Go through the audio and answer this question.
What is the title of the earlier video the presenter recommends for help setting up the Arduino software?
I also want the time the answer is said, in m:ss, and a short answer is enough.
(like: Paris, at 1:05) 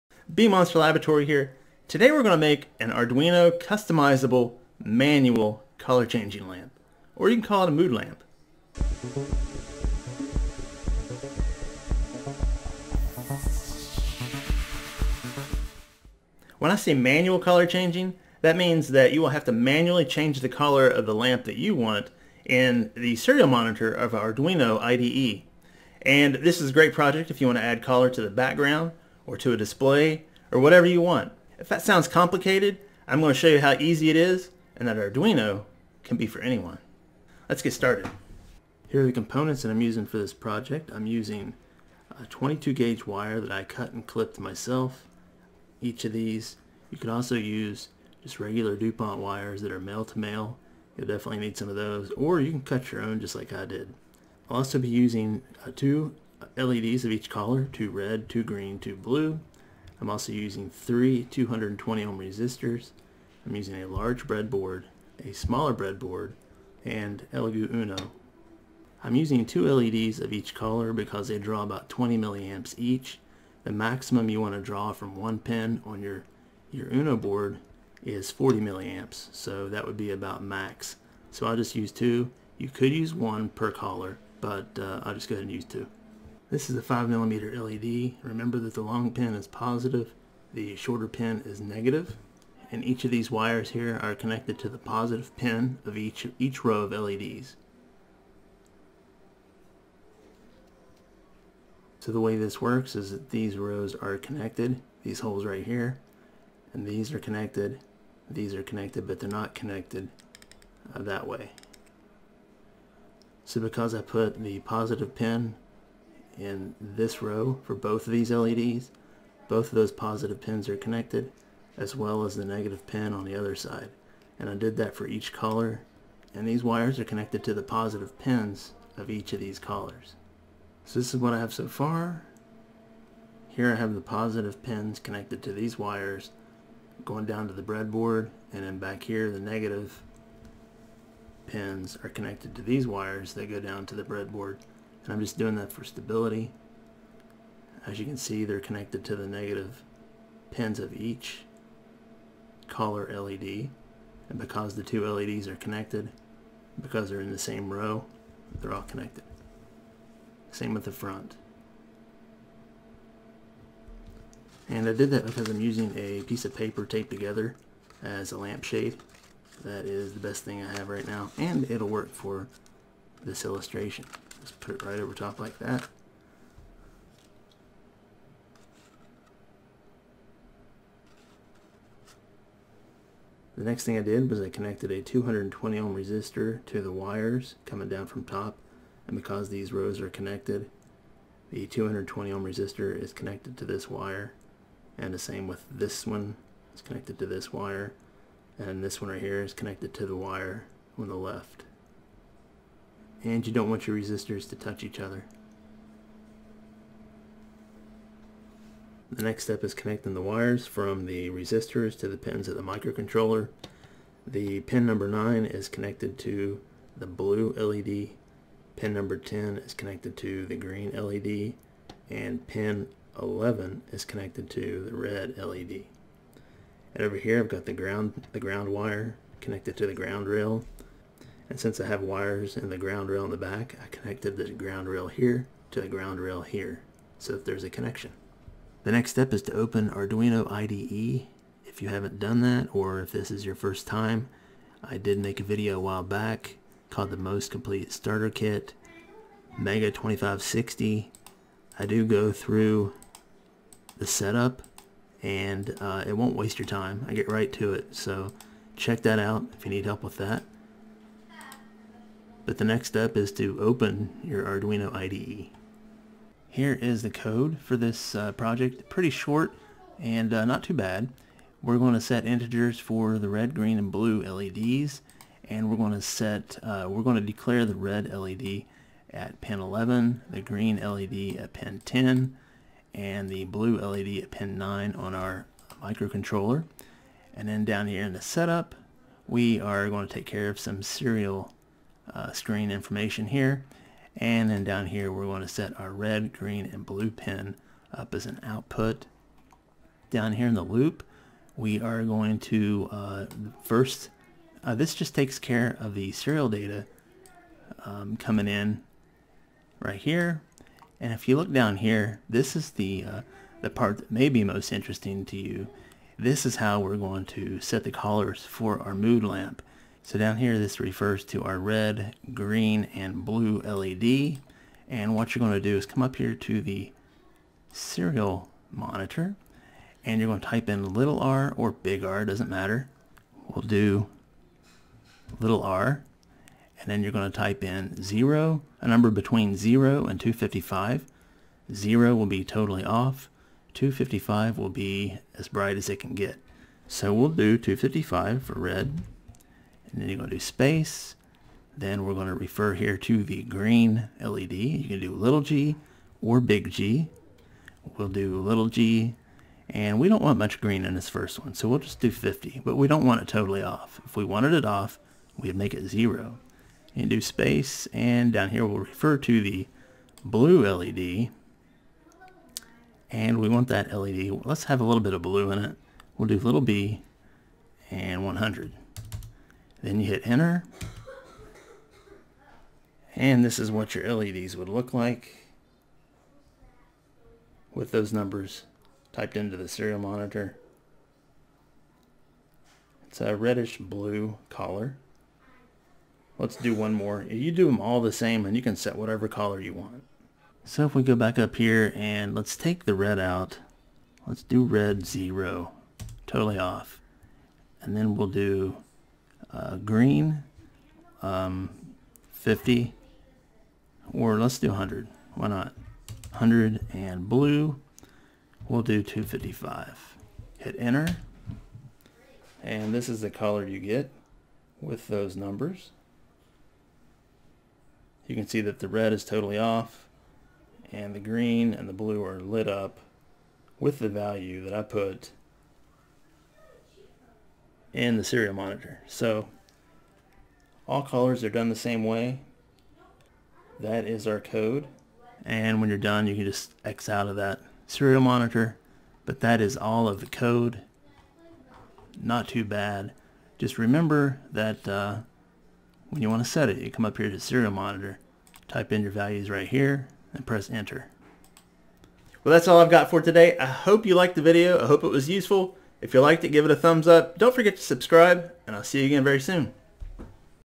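Most Complete Starter Kit, Mega 2560, at 4:07.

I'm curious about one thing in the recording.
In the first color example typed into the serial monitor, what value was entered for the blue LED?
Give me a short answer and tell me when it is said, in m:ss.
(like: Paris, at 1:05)
100, at 6:16.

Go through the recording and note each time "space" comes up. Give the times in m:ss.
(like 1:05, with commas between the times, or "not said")
5:50, 6:07.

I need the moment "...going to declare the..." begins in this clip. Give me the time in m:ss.
4:37.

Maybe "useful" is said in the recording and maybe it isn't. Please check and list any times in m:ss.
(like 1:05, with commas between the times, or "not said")
7:45.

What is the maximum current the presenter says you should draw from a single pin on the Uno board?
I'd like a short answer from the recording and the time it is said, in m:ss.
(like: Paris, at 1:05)
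40 milliamps, at 1:18.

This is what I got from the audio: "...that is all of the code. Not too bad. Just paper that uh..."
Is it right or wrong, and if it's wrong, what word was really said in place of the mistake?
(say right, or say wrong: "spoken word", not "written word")
wrong: "remember", not "paper".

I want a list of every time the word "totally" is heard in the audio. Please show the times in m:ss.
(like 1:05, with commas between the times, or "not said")
5:42, 6:03, 6:46, 7:09.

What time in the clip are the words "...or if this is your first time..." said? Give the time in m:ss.
4:02.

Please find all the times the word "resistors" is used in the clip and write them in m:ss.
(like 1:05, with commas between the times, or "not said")
1:02, 3:05, 3:12, 3:23, 3:31.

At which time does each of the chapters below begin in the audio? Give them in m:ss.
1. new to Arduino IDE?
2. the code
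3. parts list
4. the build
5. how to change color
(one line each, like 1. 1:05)
1. 3:58
2. 4:21
3. 0:38
4. 1:26
5. 5:25.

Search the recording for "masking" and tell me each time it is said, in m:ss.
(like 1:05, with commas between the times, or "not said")
not said.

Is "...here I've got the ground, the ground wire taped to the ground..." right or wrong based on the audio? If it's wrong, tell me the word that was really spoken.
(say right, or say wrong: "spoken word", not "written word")
wrong: "connected", not "taped".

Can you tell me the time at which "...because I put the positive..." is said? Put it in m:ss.
1:53.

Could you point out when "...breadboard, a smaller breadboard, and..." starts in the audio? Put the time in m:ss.
1:04.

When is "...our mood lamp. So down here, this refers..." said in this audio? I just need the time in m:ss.
5:18.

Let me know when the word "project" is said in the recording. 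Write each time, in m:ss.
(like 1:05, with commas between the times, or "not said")
0:26, 0:40, 4:28.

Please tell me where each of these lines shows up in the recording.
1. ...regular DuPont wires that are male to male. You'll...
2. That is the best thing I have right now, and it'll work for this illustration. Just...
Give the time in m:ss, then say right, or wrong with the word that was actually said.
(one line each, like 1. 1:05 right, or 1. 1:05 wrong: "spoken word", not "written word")
1. 0:48 right
2. 2:49 right.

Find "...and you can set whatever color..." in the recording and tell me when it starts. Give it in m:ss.
6:38.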